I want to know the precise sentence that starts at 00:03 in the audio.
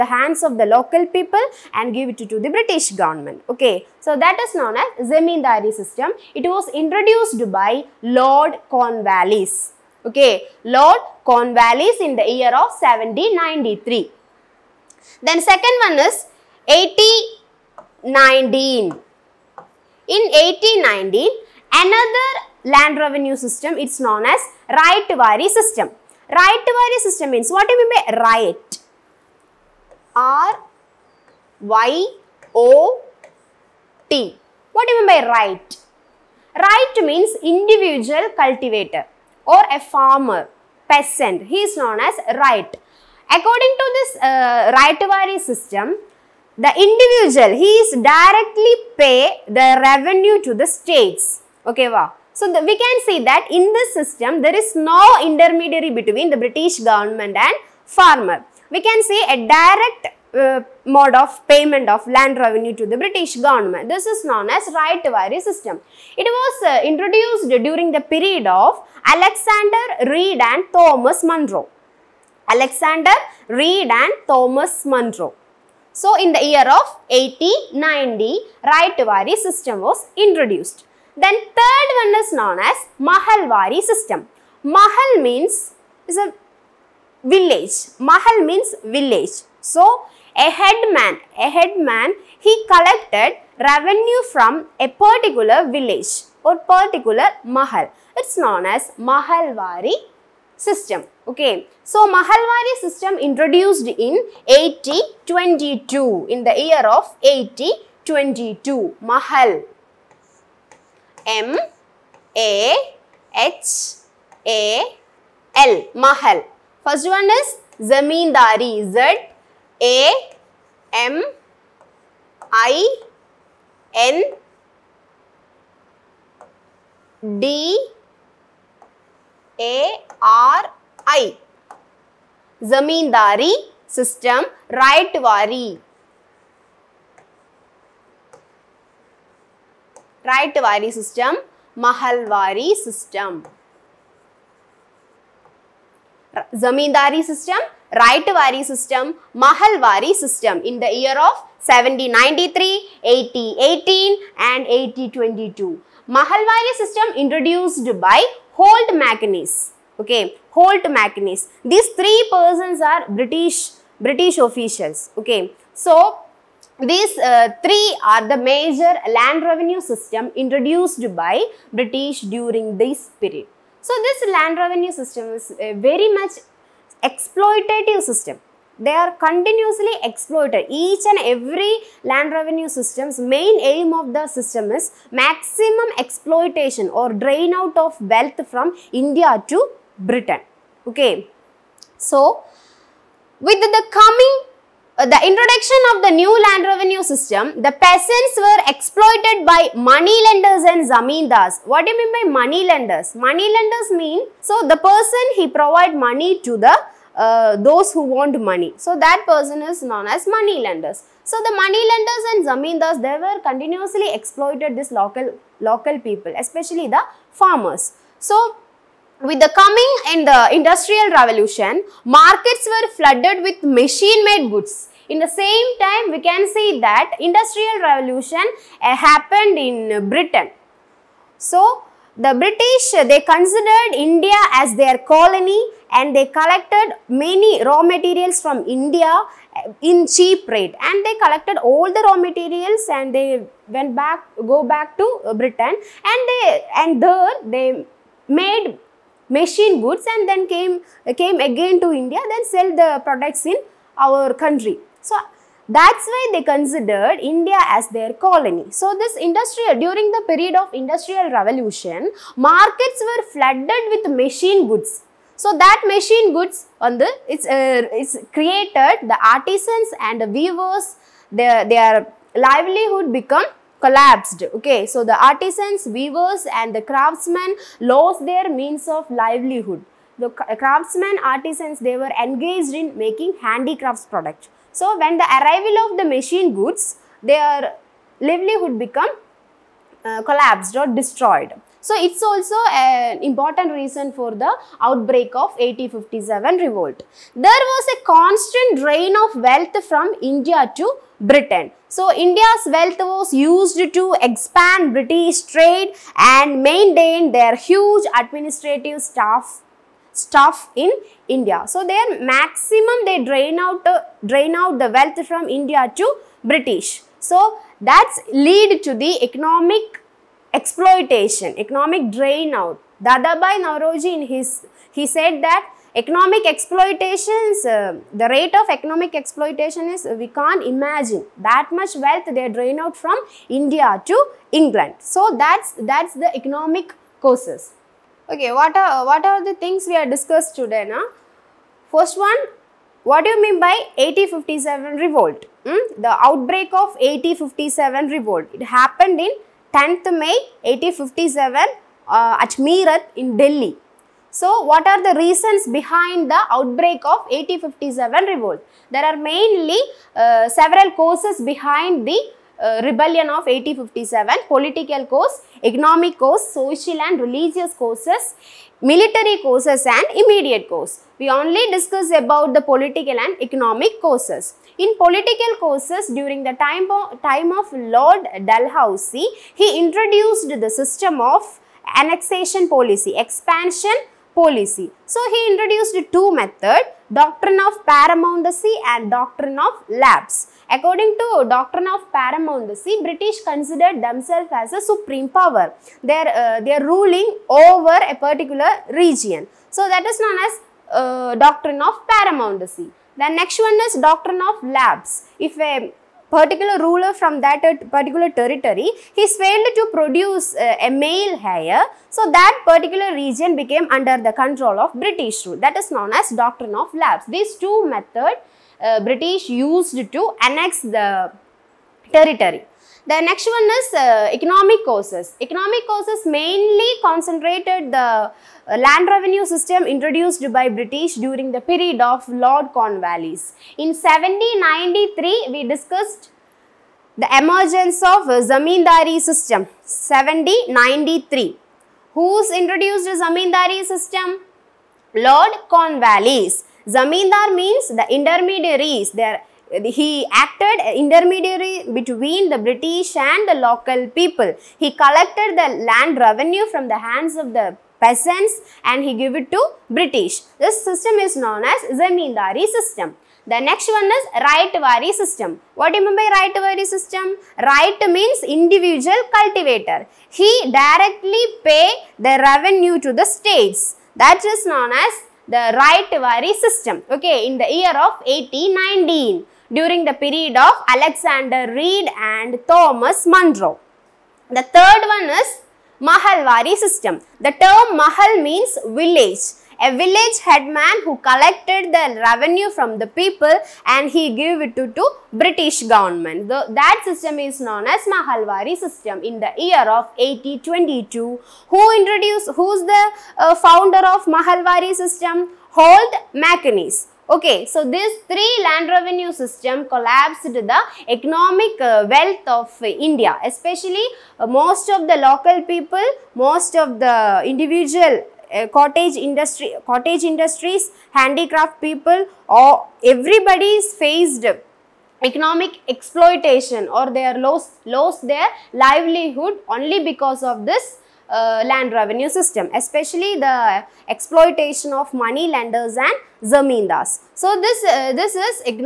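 Okay, so that is known as Zemindari system.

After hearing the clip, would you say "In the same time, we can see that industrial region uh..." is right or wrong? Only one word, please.
wrong.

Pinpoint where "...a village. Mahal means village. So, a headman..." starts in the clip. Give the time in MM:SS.
01:26.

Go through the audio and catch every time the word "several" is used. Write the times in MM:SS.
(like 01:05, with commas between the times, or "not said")
06:00.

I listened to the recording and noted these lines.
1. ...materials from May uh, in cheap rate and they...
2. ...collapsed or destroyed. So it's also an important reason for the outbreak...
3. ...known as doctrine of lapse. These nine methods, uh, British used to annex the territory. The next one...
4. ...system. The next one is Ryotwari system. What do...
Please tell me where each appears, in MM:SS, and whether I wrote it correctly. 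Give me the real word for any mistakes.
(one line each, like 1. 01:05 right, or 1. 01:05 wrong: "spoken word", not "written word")
1. 03:57 wrong: "India", not "May"
2. 04:50 right
3. 06:55 wrong: "two", not "nine"
4. 07:42 right.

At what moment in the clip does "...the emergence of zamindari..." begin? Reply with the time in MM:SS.
07:17.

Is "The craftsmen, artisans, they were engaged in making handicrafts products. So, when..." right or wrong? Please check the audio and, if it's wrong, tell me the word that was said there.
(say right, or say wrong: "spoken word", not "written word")
right.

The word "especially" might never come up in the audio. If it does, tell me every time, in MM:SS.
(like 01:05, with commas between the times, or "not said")
03:36, 08:33, 08:52.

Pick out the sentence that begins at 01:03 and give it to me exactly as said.
This is known as Ryotwari system.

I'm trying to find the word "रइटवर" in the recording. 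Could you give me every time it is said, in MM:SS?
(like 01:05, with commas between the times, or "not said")
02:14, 02:20.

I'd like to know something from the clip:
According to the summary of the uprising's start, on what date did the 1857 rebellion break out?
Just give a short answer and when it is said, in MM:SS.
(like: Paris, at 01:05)
10th May 1857, at 05:49.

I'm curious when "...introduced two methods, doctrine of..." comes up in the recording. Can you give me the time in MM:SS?
06:25.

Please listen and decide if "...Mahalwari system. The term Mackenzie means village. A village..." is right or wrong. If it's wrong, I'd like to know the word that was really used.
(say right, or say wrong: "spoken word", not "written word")
wrong: "Mahal", not "Mackenzie".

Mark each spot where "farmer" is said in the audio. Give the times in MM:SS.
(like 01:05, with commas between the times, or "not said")
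00:39, 00:57, 03:37.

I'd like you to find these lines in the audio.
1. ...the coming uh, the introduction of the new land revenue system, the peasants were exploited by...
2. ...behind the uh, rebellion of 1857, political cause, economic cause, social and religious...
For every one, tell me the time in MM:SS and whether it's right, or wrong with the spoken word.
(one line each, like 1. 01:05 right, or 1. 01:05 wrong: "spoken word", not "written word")
1. 03:13 right
2. 06:01 right.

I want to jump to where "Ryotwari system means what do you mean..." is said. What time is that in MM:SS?
00:26.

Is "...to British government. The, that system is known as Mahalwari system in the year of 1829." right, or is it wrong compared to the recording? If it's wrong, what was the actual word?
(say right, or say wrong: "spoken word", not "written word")
wrong: "1822", not "1829".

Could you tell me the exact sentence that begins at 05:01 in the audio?
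So India's wealth was used to expand British trade and maintain their huge administrative staff stuff in India.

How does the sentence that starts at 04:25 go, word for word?
So that machine goods on the, it's, uh, it's created the artisans and the weavers, their, their livelihood become collapsed.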